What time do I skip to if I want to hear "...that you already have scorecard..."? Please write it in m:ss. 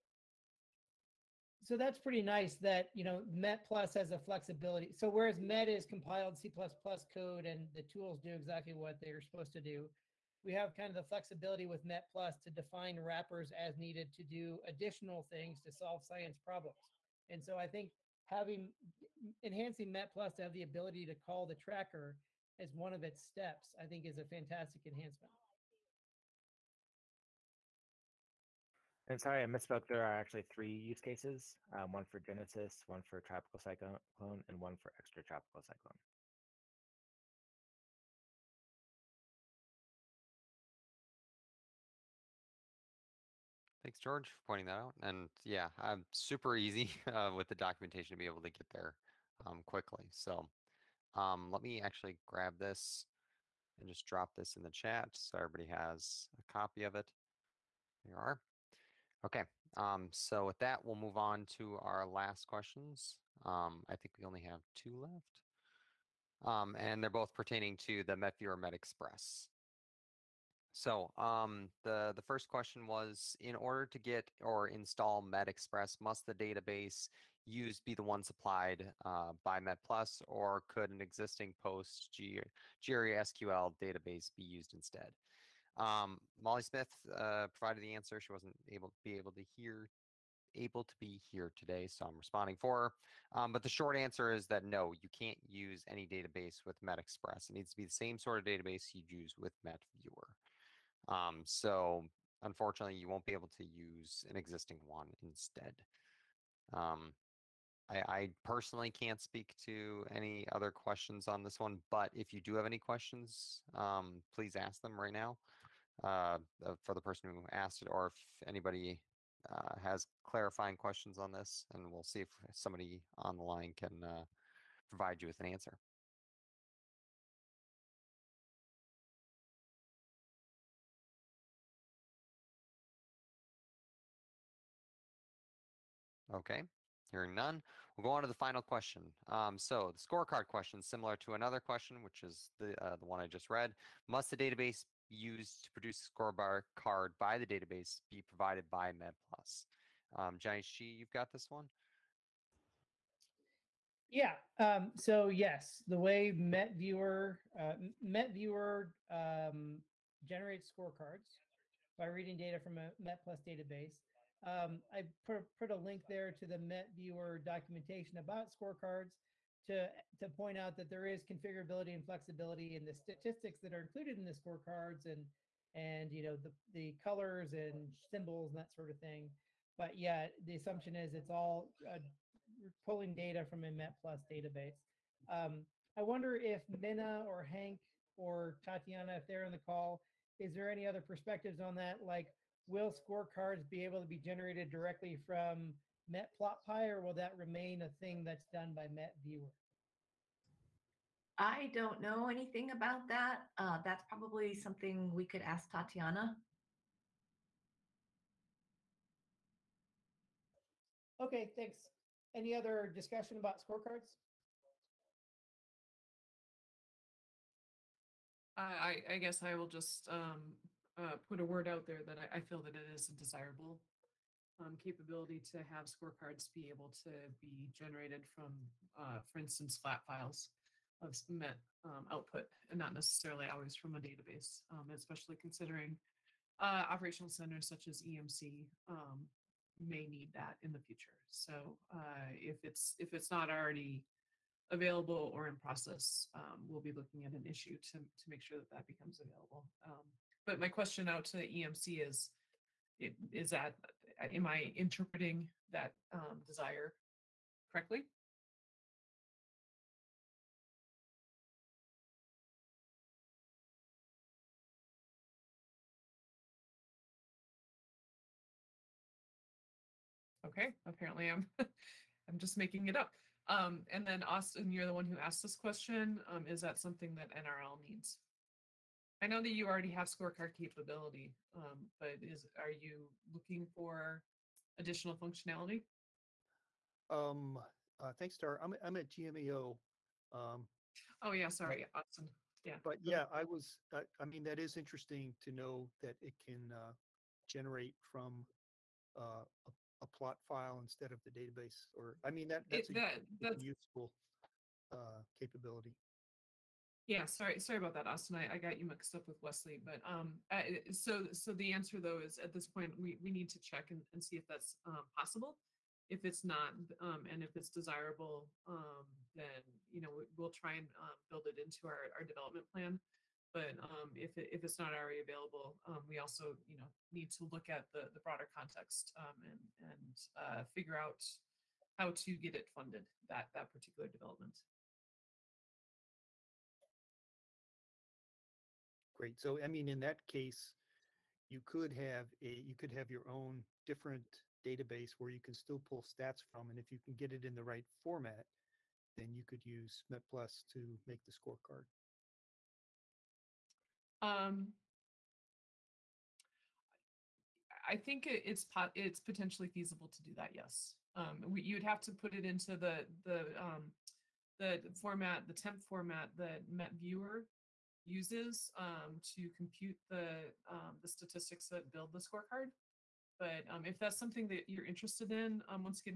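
4:39.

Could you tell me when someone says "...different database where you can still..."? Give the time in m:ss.
5:43.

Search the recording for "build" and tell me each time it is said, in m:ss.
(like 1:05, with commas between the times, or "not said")
5:21, 6:11.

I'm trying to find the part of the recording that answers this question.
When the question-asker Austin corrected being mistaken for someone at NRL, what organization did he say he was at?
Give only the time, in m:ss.
4:49.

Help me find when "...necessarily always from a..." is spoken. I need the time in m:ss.
3:52.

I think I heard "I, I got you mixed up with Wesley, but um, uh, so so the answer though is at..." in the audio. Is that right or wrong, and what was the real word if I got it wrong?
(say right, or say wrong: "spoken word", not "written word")
right.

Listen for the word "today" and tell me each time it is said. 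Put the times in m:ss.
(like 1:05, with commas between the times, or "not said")
1:31.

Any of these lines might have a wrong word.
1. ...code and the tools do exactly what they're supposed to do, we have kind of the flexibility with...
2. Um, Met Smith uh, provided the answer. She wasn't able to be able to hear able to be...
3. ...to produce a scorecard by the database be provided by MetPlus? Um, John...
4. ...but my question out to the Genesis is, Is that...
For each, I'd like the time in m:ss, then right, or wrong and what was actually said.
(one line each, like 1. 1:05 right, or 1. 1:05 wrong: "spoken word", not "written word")
1. 0:06 right
2. 1:25 wrong: "Molly", not "Met"
3. 2:25 right
4. 4:10 wrong: "EMC", not "Genesis".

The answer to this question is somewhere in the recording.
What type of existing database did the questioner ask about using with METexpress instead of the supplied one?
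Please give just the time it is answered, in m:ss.
1:21.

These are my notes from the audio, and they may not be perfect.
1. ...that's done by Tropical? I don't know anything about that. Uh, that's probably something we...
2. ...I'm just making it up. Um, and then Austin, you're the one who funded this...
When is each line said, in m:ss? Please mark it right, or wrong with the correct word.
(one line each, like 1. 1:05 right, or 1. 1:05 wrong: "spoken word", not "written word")
1. 3:18 wrong: "Viewer", not "Tropical"
2. 4:32 wrong: "asked", not "funded".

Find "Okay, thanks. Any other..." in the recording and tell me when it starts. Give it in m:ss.
3:31.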